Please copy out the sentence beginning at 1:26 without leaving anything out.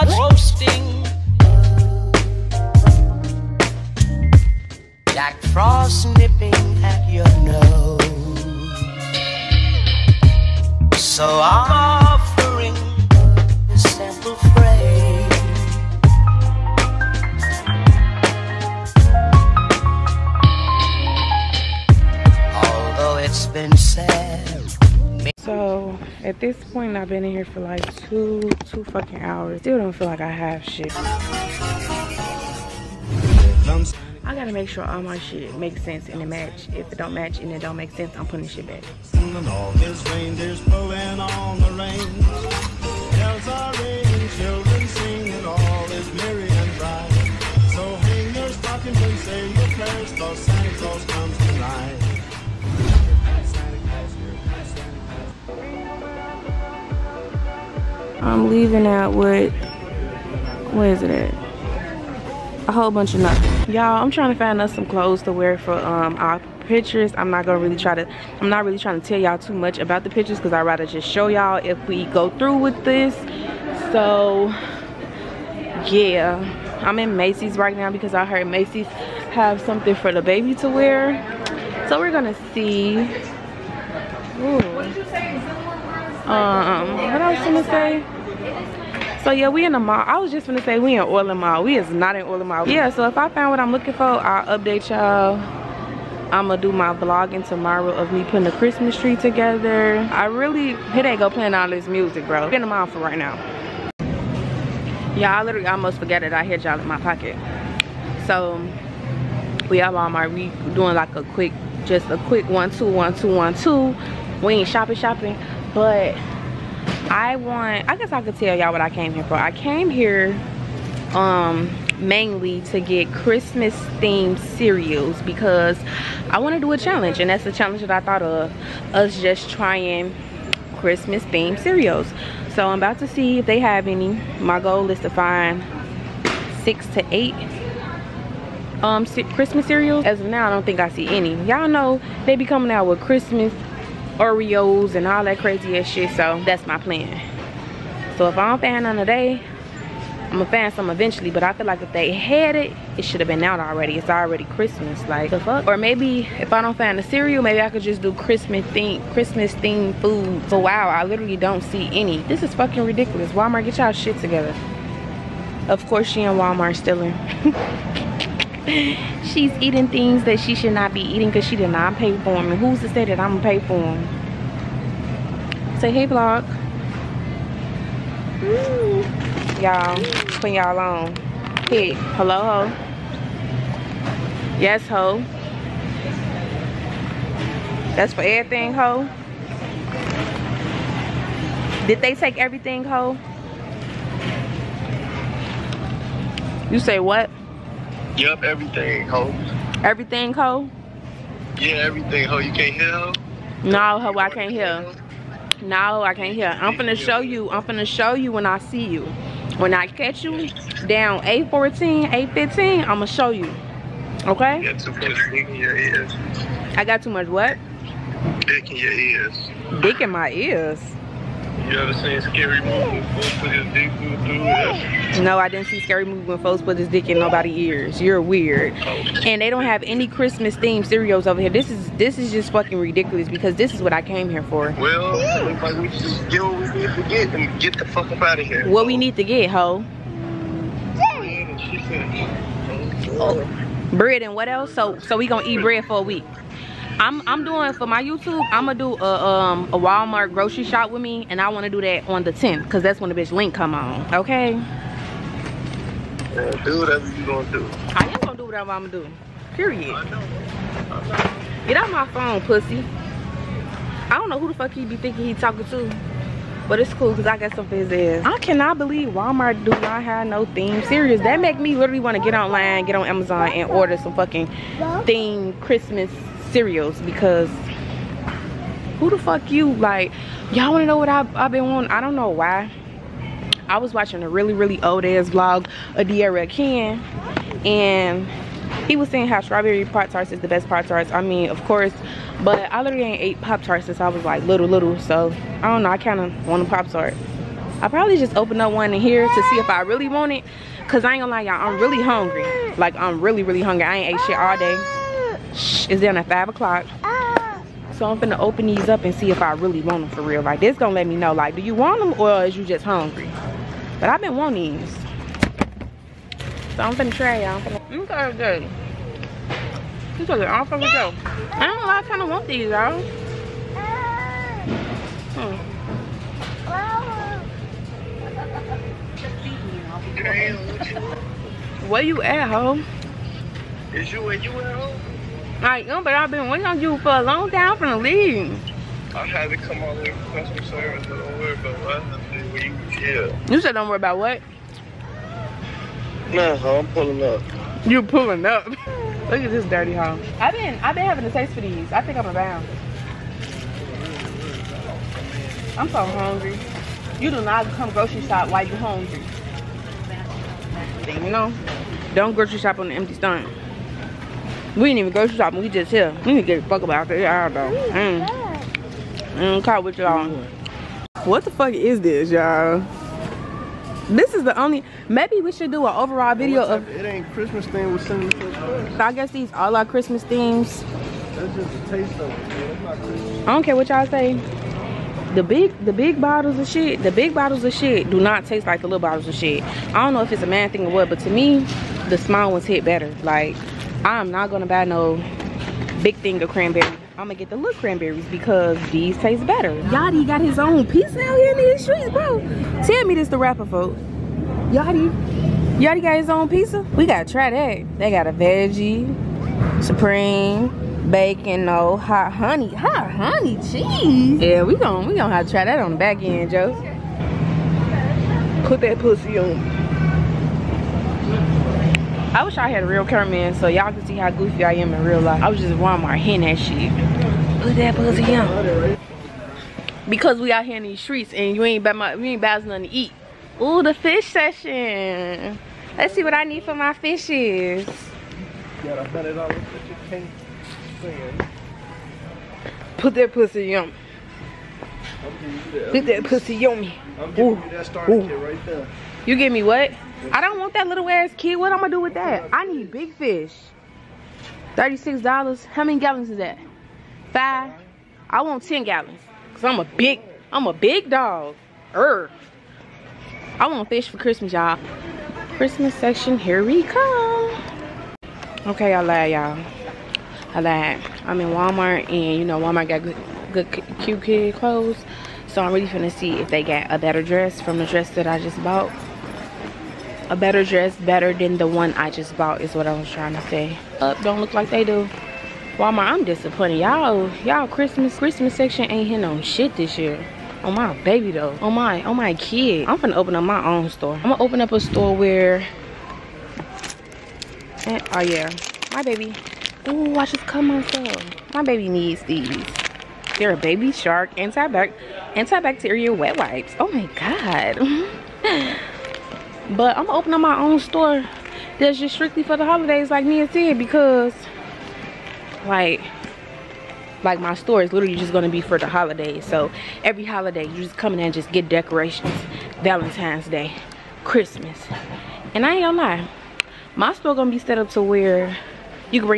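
um what i gonna say so yeah, we in the mall.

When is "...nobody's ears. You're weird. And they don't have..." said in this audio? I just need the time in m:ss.
3:47.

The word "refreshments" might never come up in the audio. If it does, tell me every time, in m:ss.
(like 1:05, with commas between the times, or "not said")
not said.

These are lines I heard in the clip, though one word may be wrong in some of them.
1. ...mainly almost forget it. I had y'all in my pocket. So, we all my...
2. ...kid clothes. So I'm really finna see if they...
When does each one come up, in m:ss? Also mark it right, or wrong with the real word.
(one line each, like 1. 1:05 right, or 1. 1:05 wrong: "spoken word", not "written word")
1. 1:45 wrong: "literally", not "mainly"
2. 7:54 right.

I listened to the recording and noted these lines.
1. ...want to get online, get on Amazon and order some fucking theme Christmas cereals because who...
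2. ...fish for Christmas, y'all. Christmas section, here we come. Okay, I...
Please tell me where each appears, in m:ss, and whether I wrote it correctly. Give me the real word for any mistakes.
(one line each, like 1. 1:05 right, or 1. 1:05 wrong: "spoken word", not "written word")
1. 4:32 right
2. 7:43 right.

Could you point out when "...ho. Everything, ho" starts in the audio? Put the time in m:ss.
3:19.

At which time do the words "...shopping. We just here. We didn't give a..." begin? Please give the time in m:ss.
6:05.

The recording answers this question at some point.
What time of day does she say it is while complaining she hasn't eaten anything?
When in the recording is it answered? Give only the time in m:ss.
5:06.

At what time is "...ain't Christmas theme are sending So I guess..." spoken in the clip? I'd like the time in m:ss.
6:17.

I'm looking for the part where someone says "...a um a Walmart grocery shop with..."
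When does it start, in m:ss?
4:08.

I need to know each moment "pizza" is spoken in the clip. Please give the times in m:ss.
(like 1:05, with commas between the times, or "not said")
6:40, 6:46.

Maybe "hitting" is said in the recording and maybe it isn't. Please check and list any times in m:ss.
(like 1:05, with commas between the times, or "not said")
7:06, 8:09.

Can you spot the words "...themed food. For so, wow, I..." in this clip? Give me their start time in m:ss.
2:39.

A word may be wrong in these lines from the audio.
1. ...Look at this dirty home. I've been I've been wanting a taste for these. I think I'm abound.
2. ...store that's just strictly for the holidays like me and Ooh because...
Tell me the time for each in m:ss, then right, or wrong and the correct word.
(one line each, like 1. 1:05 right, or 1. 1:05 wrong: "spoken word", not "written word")
1. 5:48 wrong: "having", not "wanting"
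2. 8:30 wrong: "Sid", not "Ooh".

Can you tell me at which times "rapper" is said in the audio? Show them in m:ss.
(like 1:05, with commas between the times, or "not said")
6:43.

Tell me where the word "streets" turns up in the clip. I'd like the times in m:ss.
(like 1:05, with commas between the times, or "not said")
6:41, 7:11.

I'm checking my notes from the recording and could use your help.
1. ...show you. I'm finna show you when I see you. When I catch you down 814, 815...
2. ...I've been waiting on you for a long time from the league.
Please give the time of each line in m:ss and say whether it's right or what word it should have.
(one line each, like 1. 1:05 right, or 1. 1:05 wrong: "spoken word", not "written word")
1. 3:26 right
2. 5:36 right.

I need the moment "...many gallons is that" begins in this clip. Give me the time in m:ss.
7:35.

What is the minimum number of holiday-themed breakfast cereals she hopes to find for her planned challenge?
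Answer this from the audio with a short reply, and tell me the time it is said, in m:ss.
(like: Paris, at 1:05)
6, at 2:16.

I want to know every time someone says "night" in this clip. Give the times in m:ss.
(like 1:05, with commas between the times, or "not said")
not said.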